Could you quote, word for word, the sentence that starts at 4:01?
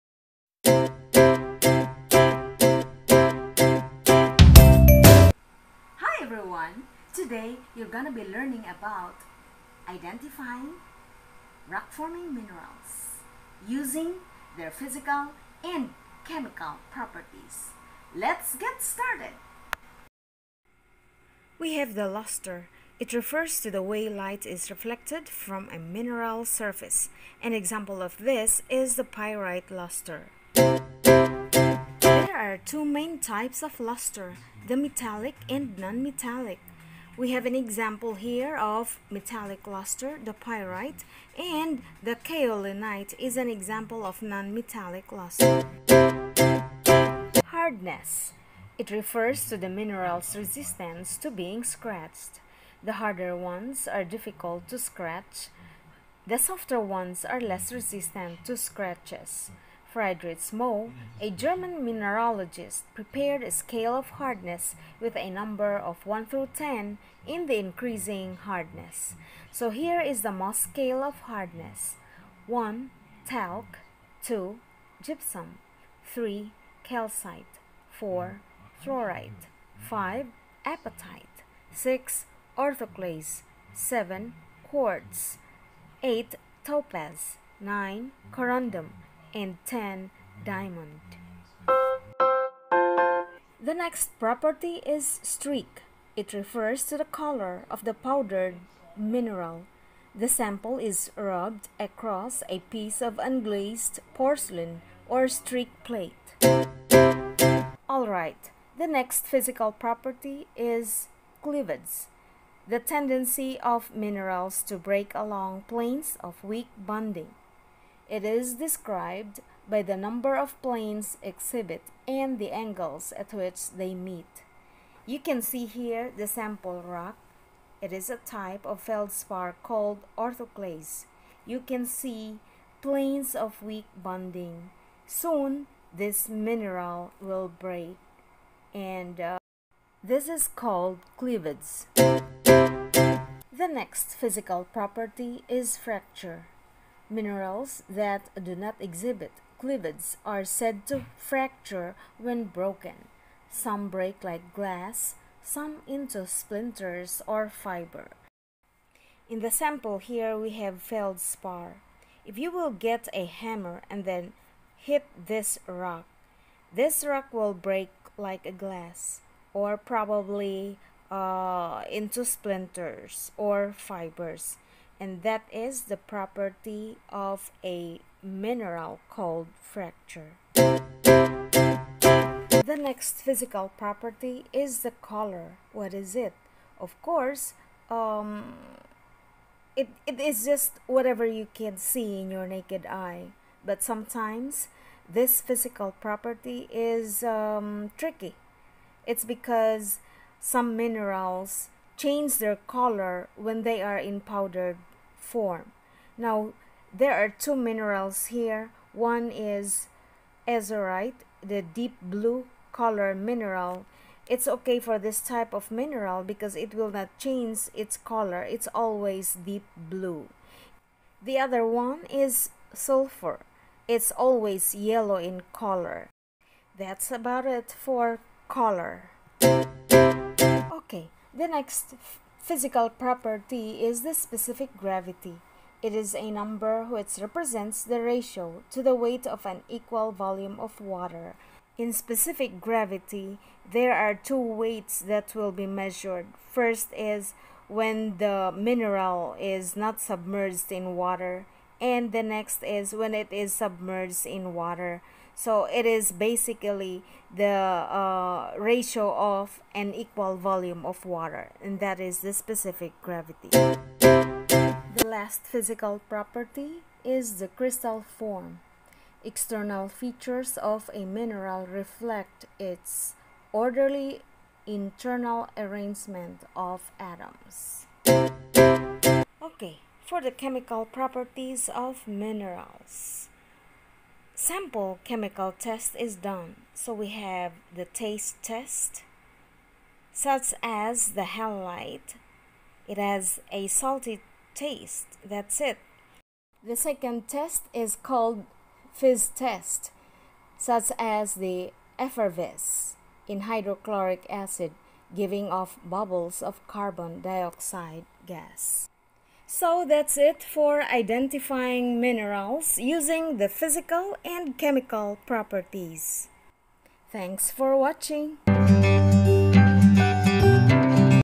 In specific gravity, there are two weights that will be measured.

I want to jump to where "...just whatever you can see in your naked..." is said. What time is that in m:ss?
3:10.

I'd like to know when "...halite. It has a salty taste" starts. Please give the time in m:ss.
4:51.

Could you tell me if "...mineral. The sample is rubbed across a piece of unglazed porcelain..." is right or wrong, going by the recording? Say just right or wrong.
right.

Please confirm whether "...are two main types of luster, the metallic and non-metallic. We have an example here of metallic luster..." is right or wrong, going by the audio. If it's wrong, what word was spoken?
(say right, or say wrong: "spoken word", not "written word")
right.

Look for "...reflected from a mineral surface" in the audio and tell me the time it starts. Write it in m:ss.
0:24.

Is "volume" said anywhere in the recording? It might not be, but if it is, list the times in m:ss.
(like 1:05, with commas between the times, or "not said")
4:00, 4:20.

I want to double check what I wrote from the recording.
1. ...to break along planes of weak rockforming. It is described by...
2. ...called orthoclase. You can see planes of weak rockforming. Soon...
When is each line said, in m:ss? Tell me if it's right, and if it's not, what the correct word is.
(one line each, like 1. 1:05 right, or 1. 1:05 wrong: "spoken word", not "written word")
1. 1:54 wrong: "bonding", not "rockforming"
2. 2:09 wrong: "bonding", not "rockforming".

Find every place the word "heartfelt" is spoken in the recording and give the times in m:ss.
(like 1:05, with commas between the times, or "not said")
not said.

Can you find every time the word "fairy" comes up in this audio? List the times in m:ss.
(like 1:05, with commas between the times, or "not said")
not said.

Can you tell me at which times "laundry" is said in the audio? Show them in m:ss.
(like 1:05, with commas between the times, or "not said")
not said.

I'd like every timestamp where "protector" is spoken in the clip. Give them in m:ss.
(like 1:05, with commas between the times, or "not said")
not said.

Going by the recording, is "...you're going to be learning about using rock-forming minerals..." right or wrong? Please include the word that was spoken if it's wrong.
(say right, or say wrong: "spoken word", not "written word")
wrong: "identifying", not "using".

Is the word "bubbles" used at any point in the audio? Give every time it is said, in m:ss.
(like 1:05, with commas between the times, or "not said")
5:05.